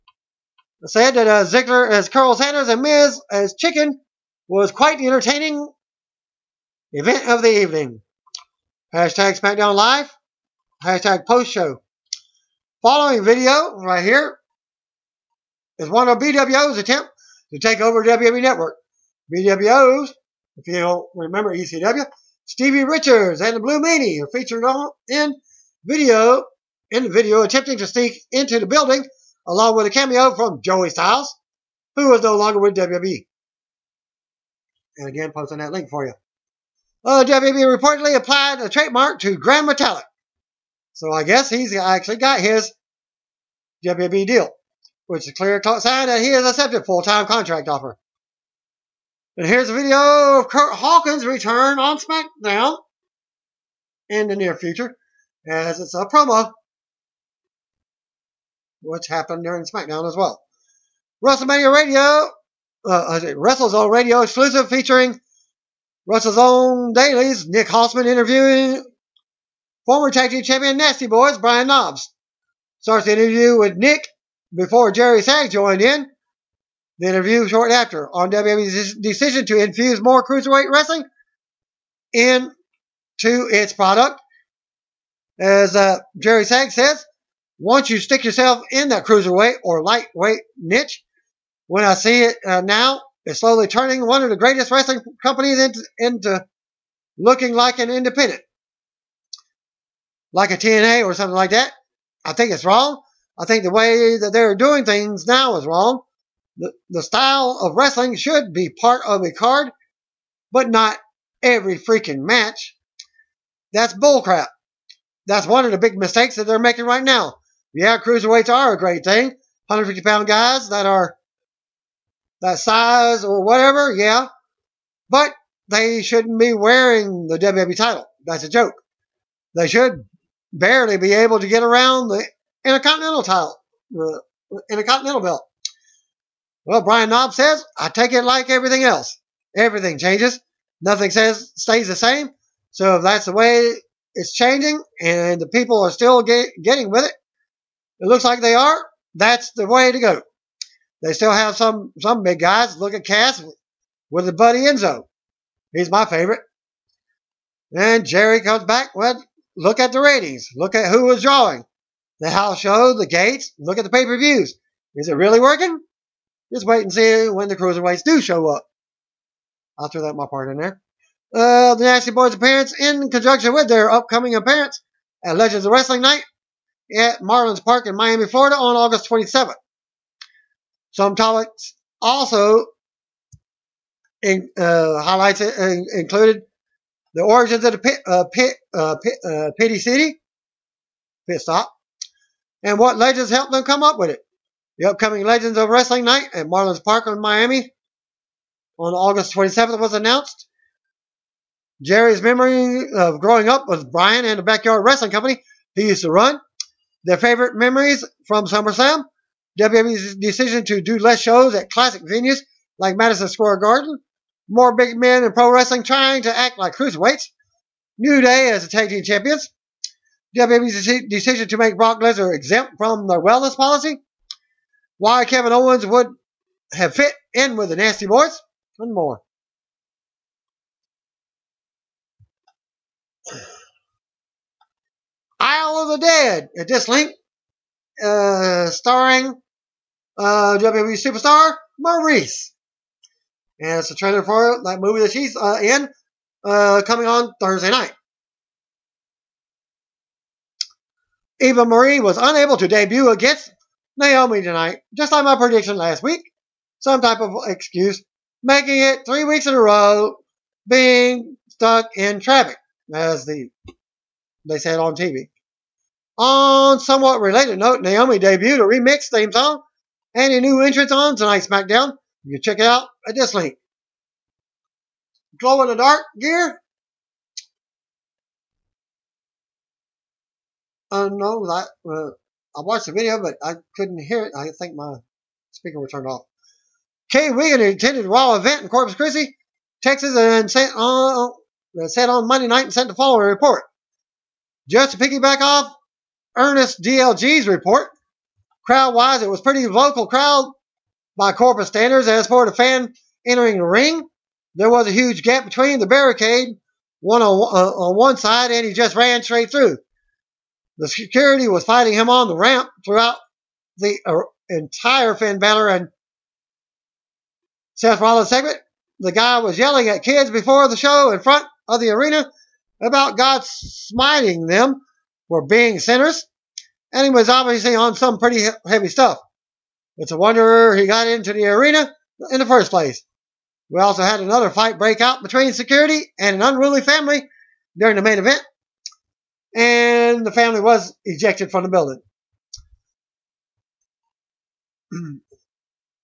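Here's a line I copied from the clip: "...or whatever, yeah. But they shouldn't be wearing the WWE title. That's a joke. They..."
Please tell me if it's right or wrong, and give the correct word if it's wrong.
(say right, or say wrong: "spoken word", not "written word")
right.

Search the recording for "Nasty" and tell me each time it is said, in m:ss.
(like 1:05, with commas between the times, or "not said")
1:10, 2:51, 3:47.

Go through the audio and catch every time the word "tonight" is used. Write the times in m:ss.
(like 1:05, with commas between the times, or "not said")
4:14, 4:31.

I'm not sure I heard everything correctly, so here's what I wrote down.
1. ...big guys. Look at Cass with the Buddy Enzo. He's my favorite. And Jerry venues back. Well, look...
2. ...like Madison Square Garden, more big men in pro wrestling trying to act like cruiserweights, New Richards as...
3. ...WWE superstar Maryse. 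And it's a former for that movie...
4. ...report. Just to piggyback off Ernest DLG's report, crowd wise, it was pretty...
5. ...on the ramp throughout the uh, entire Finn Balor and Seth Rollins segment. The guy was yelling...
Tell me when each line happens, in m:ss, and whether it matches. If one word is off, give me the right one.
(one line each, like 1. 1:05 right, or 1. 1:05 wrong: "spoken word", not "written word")
1. 2:32 wrong: "comes", not "venues"
2. 3:32 wrong: "Day", not "Richards"
3. 4:00 wrong: "trailer", not "former"
4. 4:53 right
5. 5:12 right.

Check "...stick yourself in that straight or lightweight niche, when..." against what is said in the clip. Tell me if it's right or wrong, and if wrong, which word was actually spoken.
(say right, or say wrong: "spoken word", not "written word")
wrong: "cruiserweight", not "straight".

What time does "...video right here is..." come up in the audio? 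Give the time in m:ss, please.
0:13.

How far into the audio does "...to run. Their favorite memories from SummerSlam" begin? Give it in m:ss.
3:26.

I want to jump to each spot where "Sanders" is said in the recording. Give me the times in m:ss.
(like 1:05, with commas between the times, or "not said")
0:02.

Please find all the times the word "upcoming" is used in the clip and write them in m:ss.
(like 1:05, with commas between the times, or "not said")
2:53, 3:14.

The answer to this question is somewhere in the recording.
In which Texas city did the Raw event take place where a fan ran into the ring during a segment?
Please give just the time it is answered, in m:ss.
4:48.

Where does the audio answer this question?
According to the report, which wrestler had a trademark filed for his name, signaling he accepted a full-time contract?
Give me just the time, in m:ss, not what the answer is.
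0:39.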